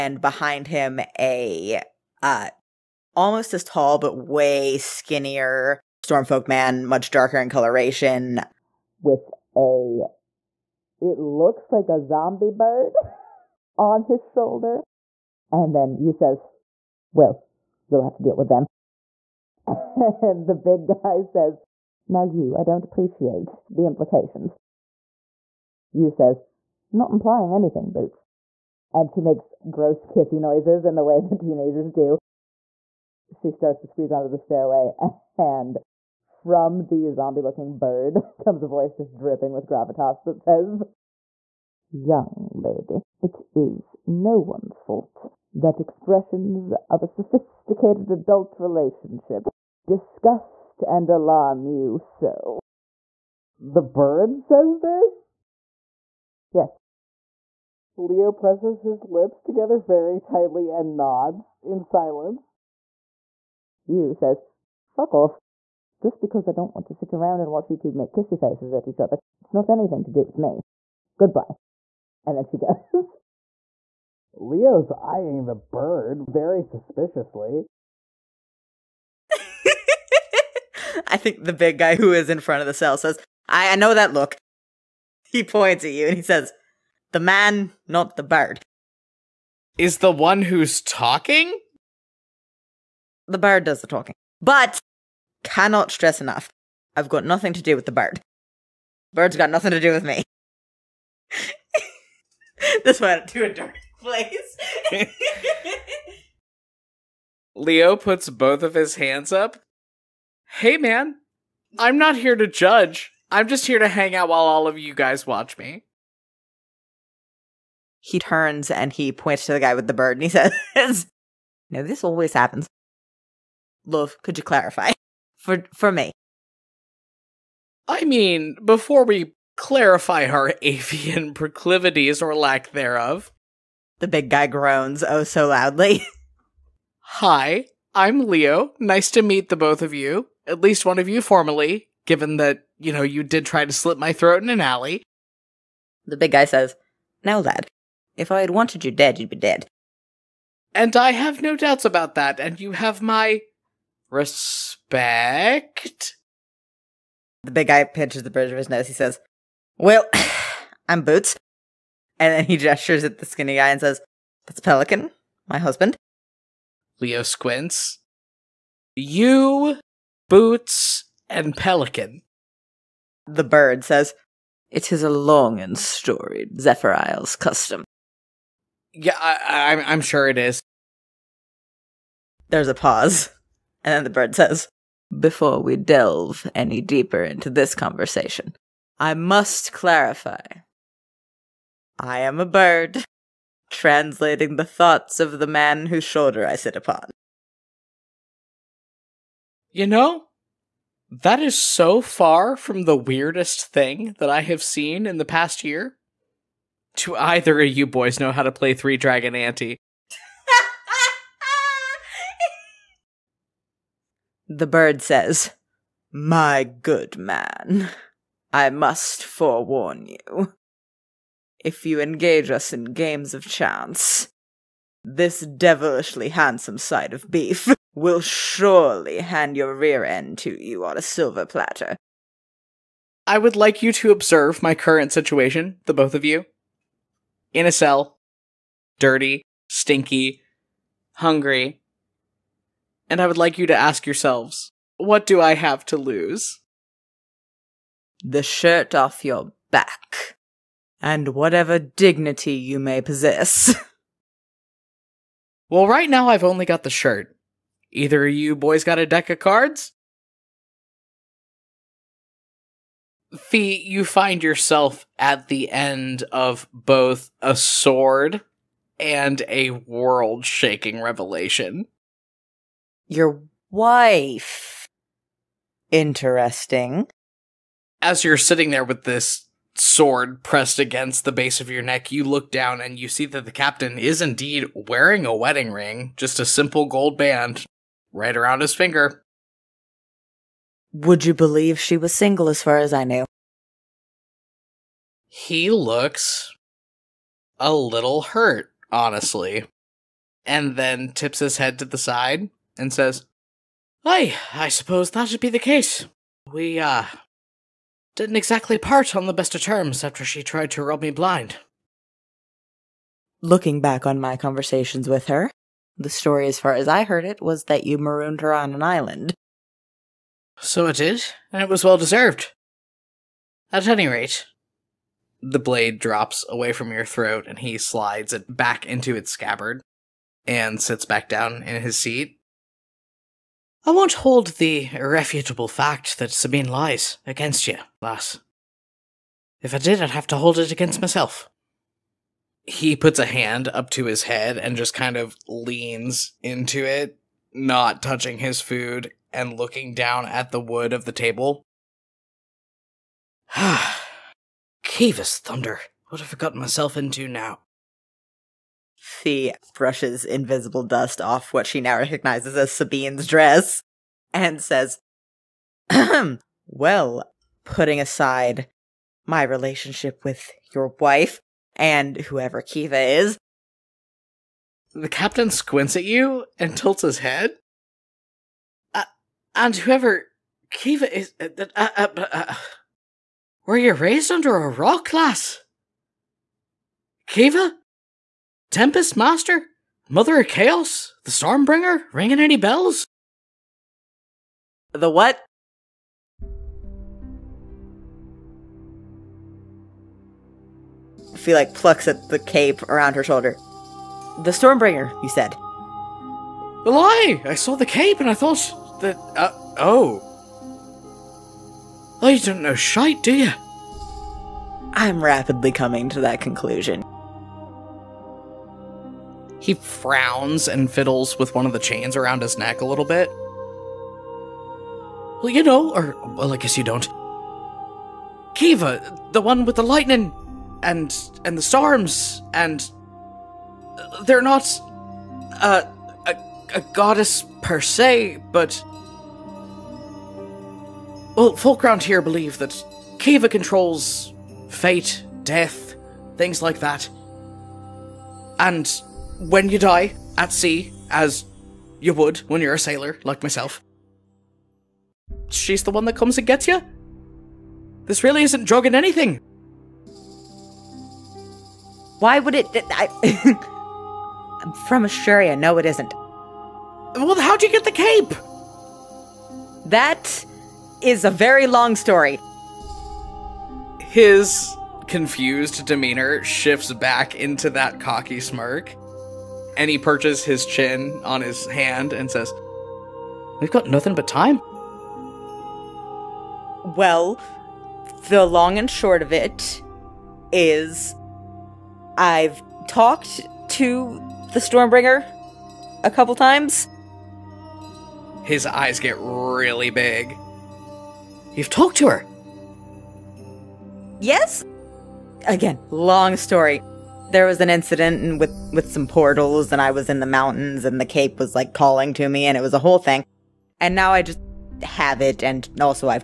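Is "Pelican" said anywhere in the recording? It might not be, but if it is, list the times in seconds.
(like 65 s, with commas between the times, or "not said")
164 s, 171 s.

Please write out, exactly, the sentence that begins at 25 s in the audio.
You says, Not implying anything, Boots.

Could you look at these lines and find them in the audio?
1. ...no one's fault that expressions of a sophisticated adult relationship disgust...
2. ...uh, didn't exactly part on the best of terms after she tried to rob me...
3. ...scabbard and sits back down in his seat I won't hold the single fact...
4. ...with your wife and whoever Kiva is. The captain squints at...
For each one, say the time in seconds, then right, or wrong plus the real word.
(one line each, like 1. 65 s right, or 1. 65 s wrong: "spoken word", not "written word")
1. 44 s right
2. 306 s right
3. 329 s wrong: "irrefutable", not "single"
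4. 370 s right.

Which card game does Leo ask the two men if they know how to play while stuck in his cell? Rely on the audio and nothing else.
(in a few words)
Three Dragon Ante.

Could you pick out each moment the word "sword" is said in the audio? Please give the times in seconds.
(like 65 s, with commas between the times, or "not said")
267 s, 279 s.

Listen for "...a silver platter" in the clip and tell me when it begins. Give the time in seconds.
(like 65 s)
230 s.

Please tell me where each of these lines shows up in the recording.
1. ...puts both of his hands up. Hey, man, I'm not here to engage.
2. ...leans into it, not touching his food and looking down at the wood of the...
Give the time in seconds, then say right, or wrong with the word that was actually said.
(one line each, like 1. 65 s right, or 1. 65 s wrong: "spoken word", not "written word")
1. 107 s wrong: "judge", not "engage"
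2. 345 s right.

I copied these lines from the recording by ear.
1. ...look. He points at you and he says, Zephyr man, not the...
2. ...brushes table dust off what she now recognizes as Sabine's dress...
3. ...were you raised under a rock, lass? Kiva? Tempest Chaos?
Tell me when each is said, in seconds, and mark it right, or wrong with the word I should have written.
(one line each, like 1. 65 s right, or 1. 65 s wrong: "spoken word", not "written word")
1. 84 s wrong: "The", not "Zephyr"
2. 359 s wrong: "invisible", not "table"
3. 383 s wrong: "Master", not "Chaos".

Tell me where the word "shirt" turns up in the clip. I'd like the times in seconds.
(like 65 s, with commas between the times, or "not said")
248 s, 256 s.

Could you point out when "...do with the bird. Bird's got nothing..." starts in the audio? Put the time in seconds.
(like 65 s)
97 s.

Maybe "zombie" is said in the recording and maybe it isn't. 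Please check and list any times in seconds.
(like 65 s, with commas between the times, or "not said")
12 s, 37 s.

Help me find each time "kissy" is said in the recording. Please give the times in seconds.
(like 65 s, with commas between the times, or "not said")
30 s, 68 s.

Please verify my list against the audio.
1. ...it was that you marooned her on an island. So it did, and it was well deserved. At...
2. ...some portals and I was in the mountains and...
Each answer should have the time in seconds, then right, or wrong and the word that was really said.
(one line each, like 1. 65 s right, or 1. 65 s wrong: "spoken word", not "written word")
1. 317 s right
2. 508 s right.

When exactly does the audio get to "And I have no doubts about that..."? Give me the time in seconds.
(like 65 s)
150 s.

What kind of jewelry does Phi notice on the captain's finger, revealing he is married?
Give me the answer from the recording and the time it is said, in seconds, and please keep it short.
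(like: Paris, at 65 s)
gold band, at 286 s.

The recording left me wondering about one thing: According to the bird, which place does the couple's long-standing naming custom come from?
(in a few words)
Zephyr Isles.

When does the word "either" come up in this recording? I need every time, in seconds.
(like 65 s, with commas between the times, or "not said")
207 s, 257 s.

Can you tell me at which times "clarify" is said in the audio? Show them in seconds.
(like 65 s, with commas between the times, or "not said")
124 s, 129 s, 189 s.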